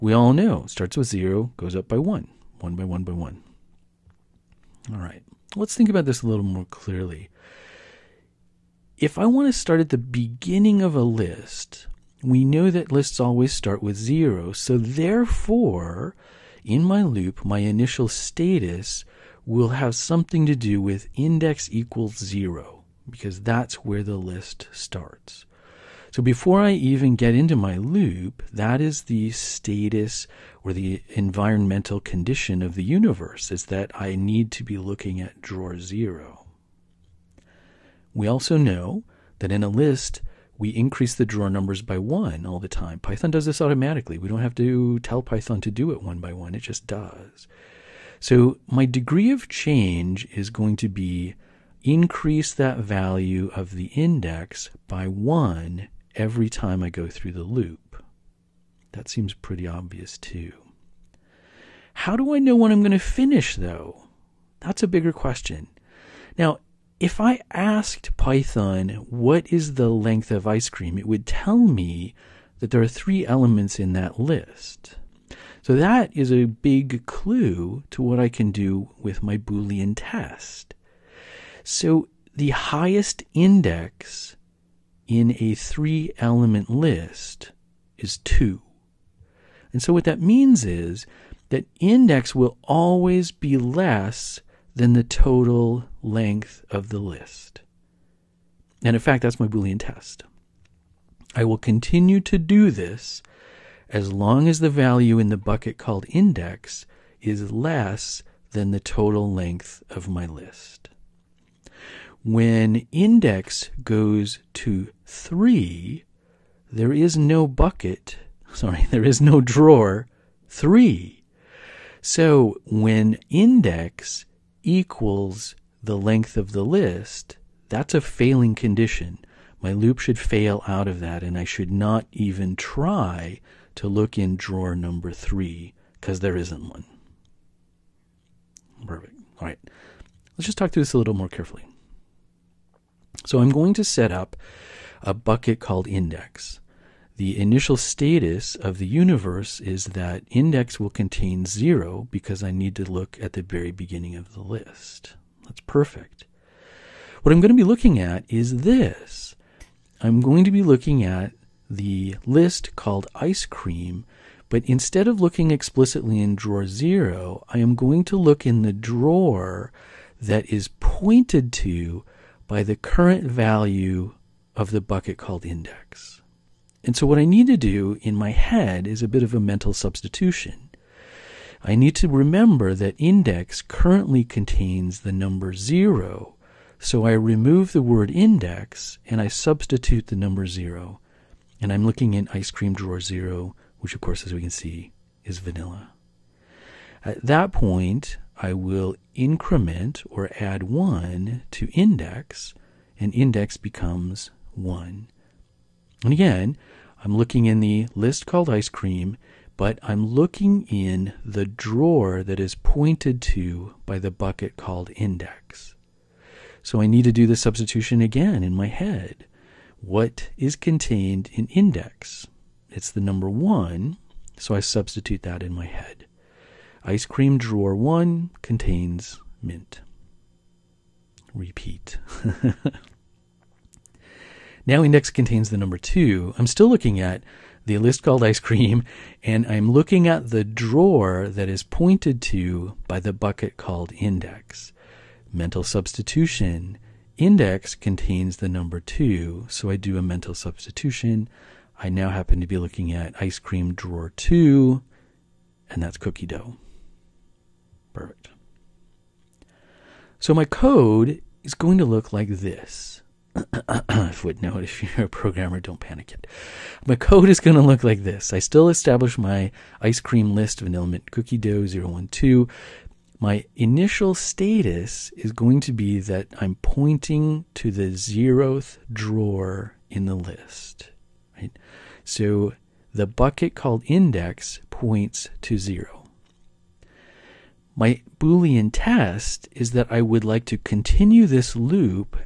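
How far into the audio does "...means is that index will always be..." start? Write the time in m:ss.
1:30.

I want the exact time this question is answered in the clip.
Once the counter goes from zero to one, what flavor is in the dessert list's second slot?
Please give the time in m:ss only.
3:49.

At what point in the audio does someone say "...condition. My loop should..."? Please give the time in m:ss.
2:08.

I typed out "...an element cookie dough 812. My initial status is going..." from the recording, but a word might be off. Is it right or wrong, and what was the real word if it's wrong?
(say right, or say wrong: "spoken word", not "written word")
wrong: "012", not "812".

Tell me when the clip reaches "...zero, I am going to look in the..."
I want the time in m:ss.
2:46.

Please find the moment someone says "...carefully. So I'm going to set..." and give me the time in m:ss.
2:21.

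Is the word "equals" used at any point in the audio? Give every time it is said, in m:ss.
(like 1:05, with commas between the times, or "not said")
0:21, 2:04.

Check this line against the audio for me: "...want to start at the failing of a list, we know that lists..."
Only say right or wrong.
wrong.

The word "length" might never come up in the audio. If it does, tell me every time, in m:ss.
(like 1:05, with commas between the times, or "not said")
1:09, 1:36, 1:49, 2:05.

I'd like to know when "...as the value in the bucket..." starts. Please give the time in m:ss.
1:44.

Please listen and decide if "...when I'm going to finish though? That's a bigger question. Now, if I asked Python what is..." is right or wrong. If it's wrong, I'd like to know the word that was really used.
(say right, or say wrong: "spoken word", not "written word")
right.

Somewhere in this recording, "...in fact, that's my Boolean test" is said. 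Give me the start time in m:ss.
1:38.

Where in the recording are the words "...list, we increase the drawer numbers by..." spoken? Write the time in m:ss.
0:39.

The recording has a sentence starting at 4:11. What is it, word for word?
I now happen to be looking at ice cream drawer 2, and that's cookie dough.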